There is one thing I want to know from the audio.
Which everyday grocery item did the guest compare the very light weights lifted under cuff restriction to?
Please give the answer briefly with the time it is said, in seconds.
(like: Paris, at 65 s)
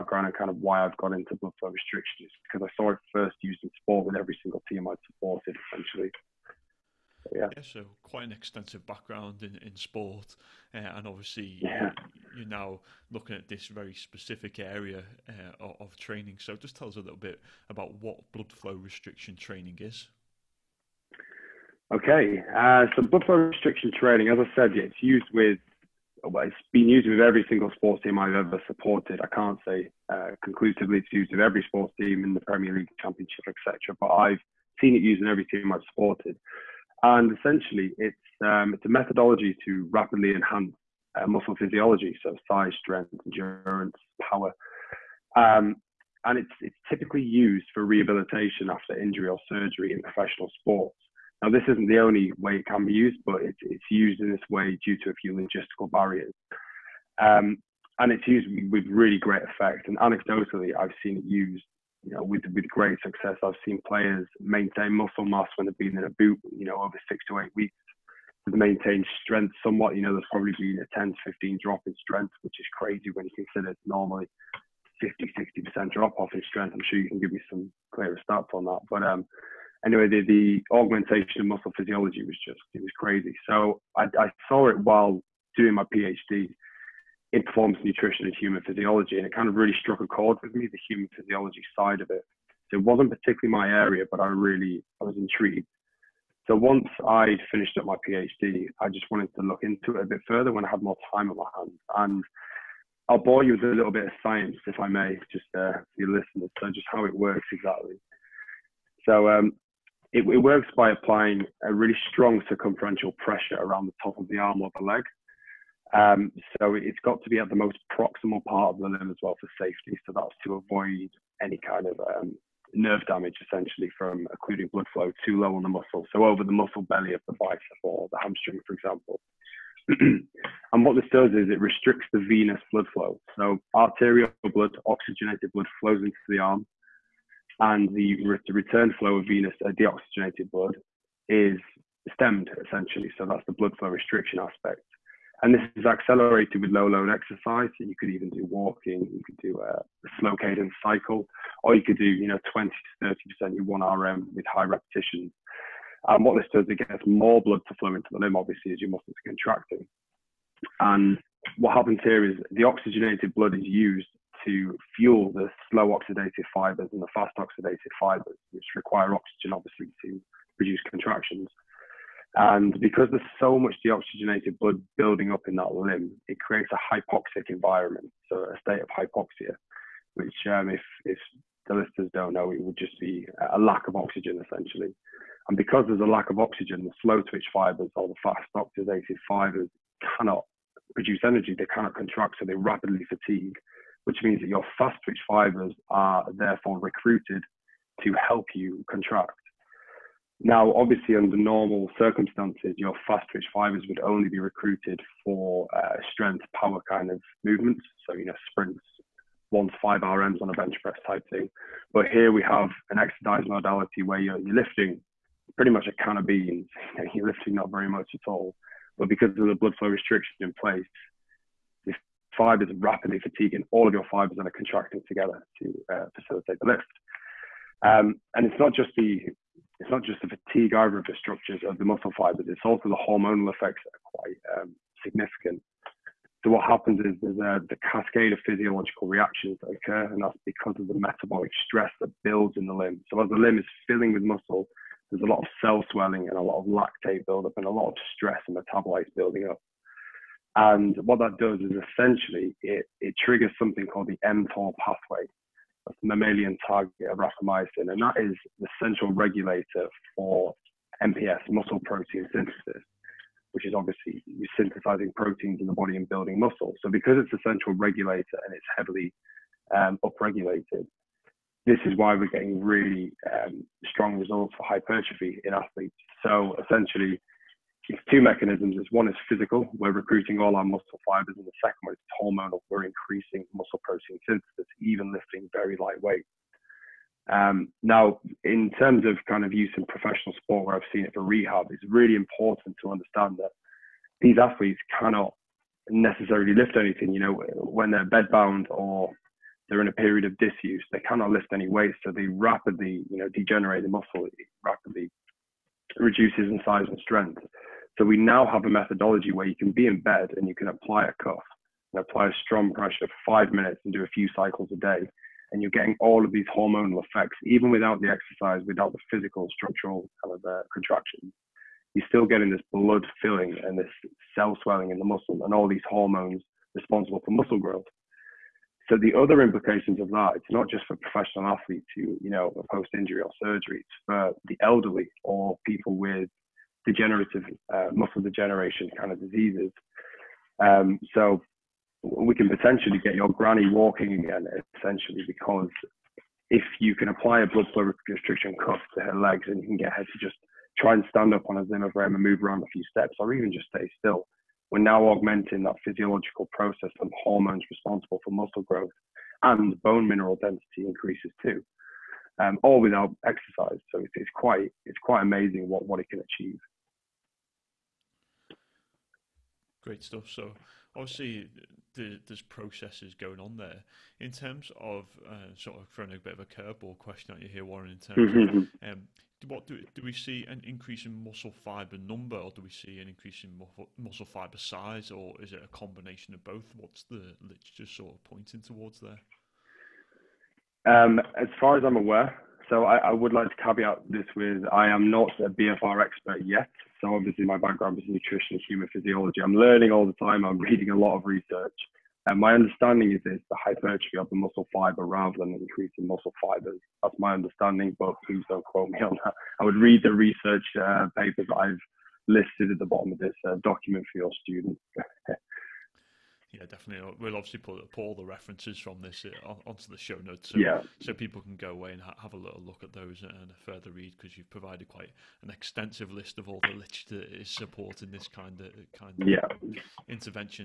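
a can of beans, at 215 s.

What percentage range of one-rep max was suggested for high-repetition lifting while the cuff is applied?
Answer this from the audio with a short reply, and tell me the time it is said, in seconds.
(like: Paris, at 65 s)
20 to 30%, at 152 s.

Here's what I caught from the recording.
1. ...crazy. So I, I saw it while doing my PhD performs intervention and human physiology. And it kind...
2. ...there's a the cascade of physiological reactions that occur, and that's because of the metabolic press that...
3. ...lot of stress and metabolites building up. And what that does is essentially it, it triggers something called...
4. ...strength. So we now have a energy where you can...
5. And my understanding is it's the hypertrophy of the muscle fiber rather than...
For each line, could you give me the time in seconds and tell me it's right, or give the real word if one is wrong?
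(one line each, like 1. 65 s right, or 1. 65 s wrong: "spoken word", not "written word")
1. 82 s wrong: "nutrition", not "intervention"
2. 237 s wrong: "stress", not "press"
3. 247 s right
4. 307 s wrong: "methodology", not "energy"
5. 402 s right.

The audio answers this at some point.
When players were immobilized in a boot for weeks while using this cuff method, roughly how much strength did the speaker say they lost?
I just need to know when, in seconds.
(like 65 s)
70 s.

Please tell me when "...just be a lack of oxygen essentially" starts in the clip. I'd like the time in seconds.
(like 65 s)
182 s.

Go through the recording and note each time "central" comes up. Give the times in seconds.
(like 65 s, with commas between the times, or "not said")
258 s, 267 s.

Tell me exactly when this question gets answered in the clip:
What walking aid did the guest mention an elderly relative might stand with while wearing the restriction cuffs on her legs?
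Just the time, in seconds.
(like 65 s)
351 s.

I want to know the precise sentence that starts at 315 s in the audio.
And you're getting all of these hormonal effects, even without the exercise, without the physical structural kind of uh, contractions.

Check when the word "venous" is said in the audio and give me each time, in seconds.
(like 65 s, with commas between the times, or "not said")
132 s, 139 s.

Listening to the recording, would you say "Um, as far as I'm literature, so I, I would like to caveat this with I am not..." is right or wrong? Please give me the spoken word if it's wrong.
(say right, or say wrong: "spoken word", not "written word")
wrong: "aware", not "literature".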